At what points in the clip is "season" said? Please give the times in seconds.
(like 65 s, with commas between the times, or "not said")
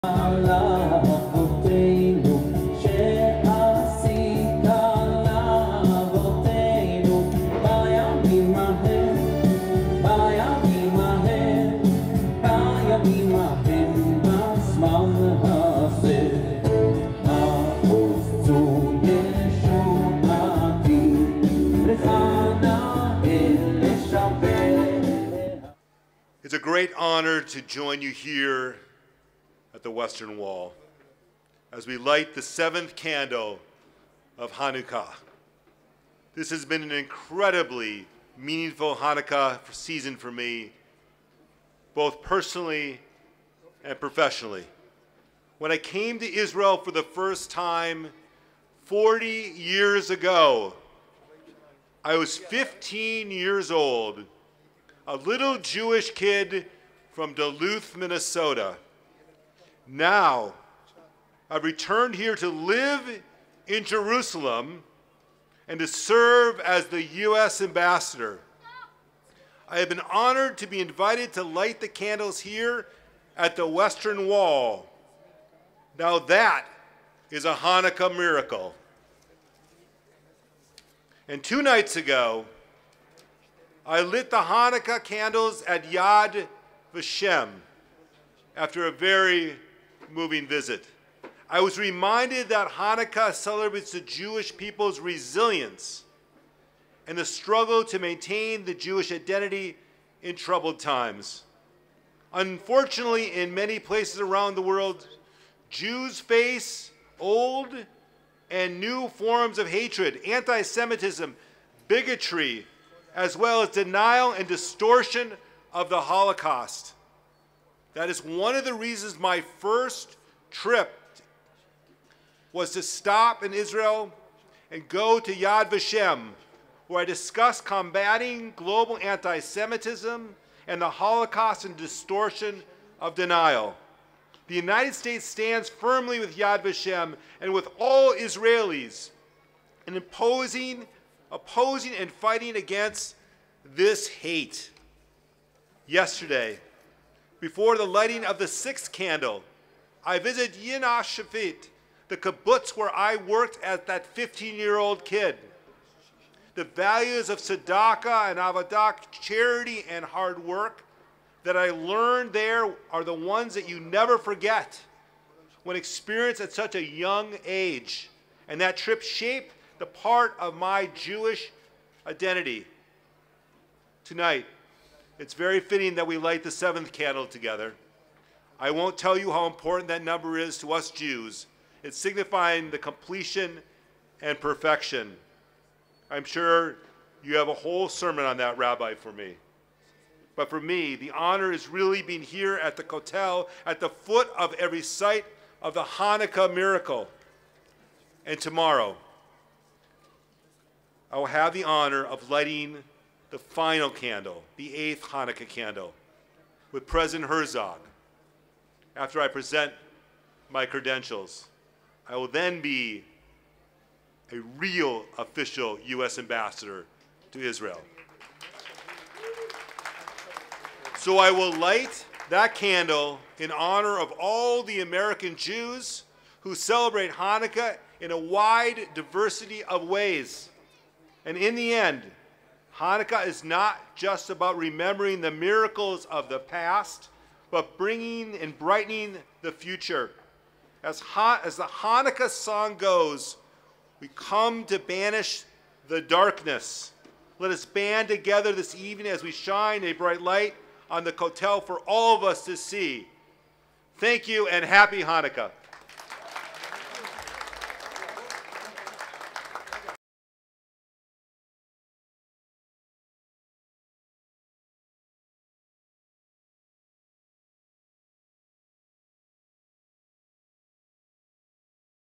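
39 s.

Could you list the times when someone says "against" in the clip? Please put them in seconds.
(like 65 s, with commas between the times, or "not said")
142 s.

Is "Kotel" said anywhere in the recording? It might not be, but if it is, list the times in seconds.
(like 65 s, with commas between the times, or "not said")
192 s, 251 s.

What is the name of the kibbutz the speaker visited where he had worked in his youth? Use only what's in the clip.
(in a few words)
Ein HaShofet.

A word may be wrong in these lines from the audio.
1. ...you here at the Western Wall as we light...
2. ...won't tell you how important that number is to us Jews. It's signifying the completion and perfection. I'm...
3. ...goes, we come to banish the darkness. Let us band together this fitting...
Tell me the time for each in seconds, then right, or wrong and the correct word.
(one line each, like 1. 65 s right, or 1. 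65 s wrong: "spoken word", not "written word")
1. 28 s right
2. 178 s right
3. 242 s wrong: "evening", not "fitting".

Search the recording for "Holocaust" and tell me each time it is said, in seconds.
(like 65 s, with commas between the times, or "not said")
115 s, 130 s.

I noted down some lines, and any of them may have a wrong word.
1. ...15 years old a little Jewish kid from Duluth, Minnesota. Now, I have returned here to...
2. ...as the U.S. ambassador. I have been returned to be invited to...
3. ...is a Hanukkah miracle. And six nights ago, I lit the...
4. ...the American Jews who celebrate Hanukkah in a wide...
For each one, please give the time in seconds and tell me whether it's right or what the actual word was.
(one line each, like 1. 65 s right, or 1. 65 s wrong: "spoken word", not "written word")
1. 52 s right
2. 66 s wrong: "honored", not "returned"
3. 77 s wrong: "two", not "six"
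4. 224 s right.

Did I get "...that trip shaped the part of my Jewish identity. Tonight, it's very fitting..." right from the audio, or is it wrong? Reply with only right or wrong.
right.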